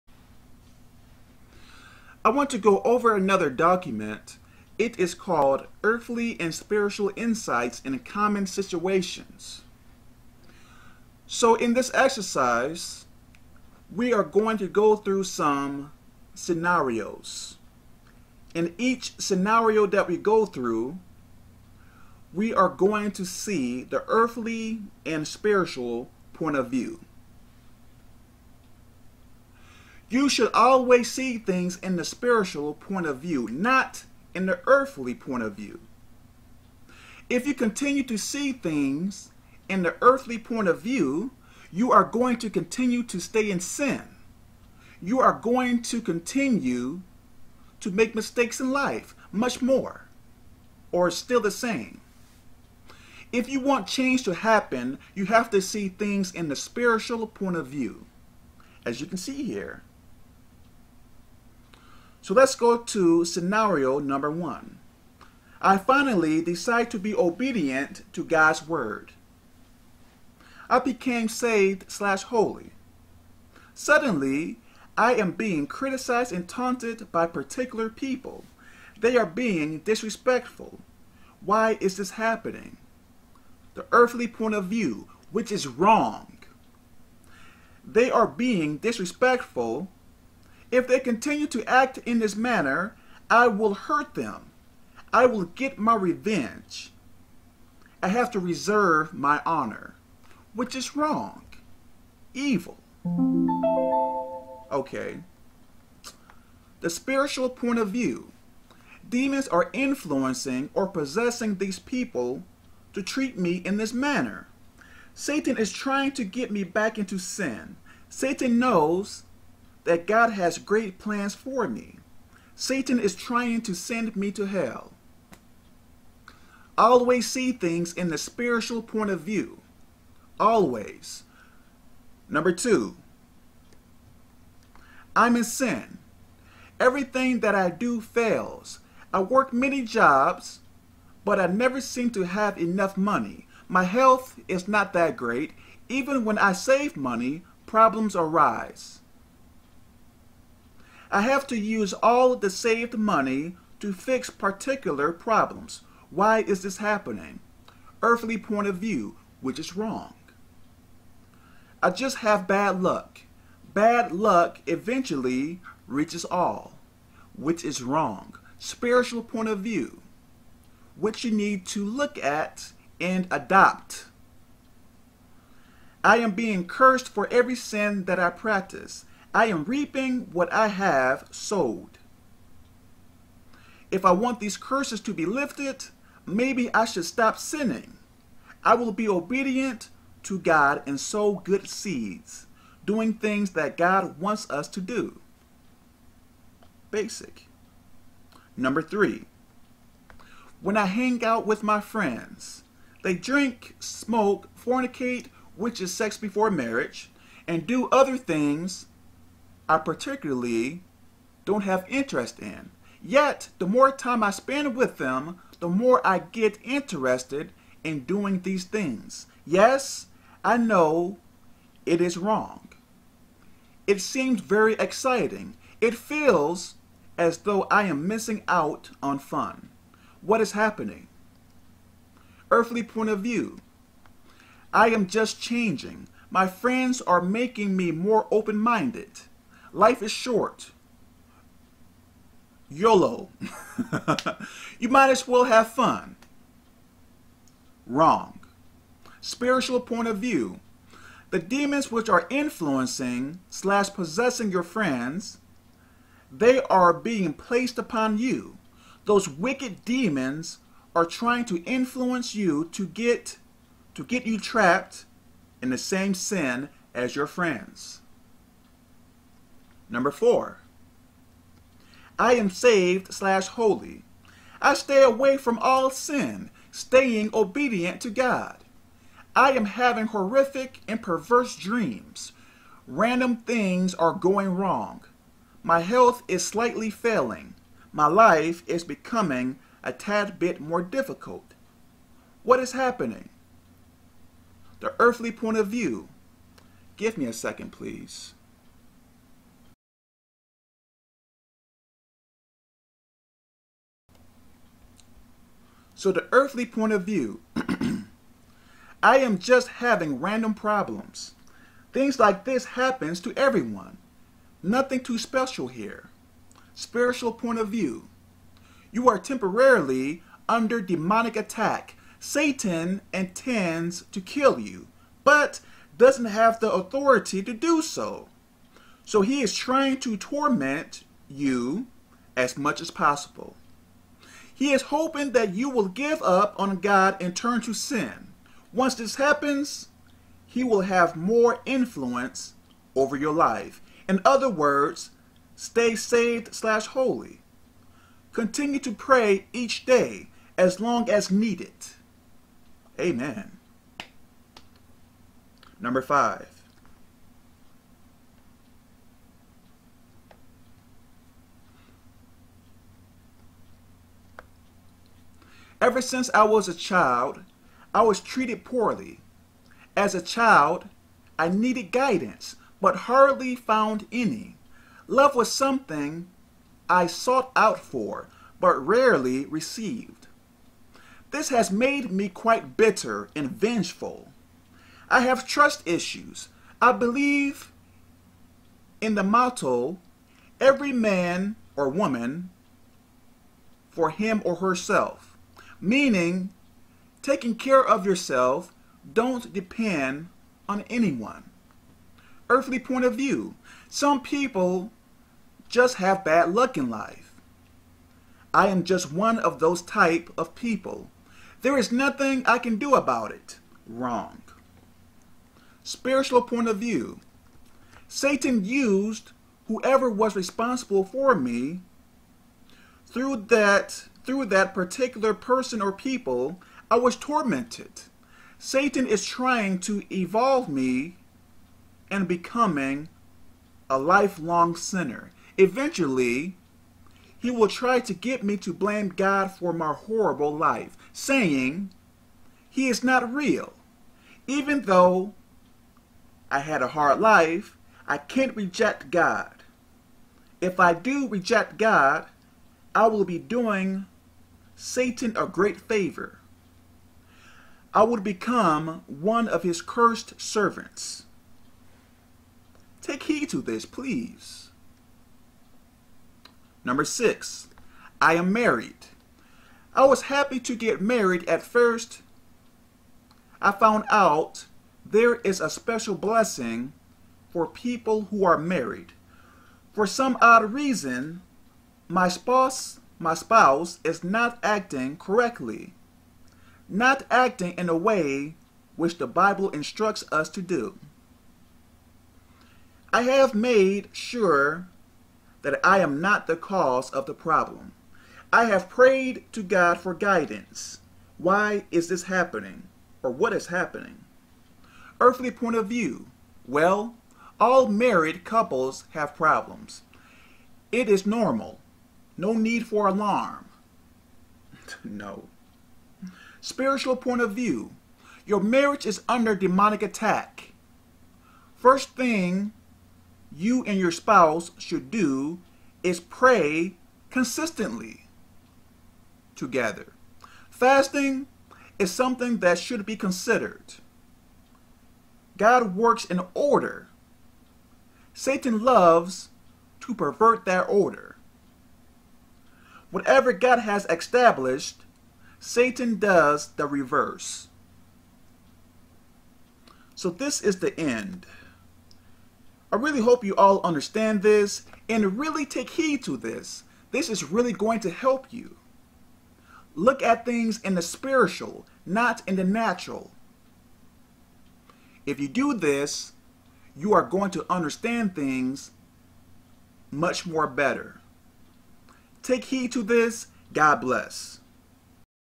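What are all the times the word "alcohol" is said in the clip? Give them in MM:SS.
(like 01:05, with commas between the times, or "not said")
not said.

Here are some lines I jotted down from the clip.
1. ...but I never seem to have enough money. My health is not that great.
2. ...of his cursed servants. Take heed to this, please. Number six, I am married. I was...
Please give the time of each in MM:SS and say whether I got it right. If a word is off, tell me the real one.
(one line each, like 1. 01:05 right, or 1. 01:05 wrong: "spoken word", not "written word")
1. 02:21 right
2. 07:39 right.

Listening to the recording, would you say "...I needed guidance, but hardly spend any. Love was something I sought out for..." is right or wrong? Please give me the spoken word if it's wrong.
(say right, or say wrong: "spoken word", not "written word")
wrong: "found", not "spend".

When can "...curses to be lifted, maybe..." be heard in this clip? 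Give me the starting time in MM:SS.
03:04.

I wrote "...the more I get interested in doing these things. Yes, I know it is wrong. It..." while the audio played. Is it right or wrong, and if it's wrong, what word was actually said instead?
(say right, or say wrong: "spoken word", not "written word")
right.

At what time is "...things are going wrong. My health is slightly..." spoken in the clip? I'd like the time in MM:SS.
04:43.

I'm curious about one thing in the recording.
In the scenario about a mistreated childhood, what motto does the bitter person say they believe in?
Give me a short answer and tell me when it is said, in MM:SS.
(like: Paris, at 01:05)
Every man or woman for him or herself, at 06:30.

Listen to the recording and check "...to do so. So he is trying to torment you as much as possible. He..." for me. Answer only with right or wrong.
right.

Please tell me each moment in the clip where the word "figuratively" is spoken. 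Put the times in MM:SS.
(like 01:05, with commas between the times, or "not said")
not said.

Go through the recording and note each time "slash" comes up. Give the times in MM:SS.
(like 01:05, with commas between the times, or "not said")
01:11, 04:13, 04:33, 05:46.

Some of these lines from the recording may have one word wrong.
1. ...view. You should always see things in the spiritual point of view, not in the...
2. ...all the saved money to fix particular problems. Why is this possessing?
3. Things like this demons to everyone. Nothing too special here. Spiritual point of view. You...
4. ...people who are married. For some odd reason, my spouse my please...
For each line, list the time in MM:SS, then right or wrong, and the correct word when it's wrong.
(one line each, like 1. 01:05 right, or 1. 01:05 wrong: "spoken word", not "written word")
1. 00:26 right
2. 02:31 wrong: "happening", not "possessing"
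3. 05:11 wrong: "happens", not "demons"
4. 07:57 wrong: "spouse", not "please".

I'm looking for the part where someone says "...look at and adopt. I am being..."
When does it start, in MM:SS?
02:51.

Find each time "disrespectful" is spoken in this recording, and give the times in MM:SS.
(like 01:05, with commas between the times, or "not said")
01:19, 01:28.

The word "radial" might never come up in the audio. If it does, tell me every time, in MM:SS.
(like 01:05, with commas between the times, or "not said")
not said.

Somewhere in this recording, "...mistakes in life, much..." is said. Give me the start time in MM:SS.
00:48.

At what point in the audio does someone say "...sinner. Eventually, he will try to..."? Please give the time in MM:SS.
07:14.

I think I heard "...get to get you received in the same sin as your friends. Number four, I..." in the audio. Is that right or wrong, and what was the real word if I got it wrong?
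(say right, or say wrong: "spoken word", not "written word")
wrong: "trapped", not "received".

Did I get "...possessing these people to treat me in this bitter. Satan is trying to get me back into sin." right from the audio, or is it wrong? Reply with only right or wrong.
wrong.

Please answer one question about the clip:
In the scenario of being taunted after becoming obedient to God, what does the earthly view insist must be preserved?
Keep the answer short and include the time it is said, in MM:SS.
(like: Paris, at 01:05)
My honor, at 01:38.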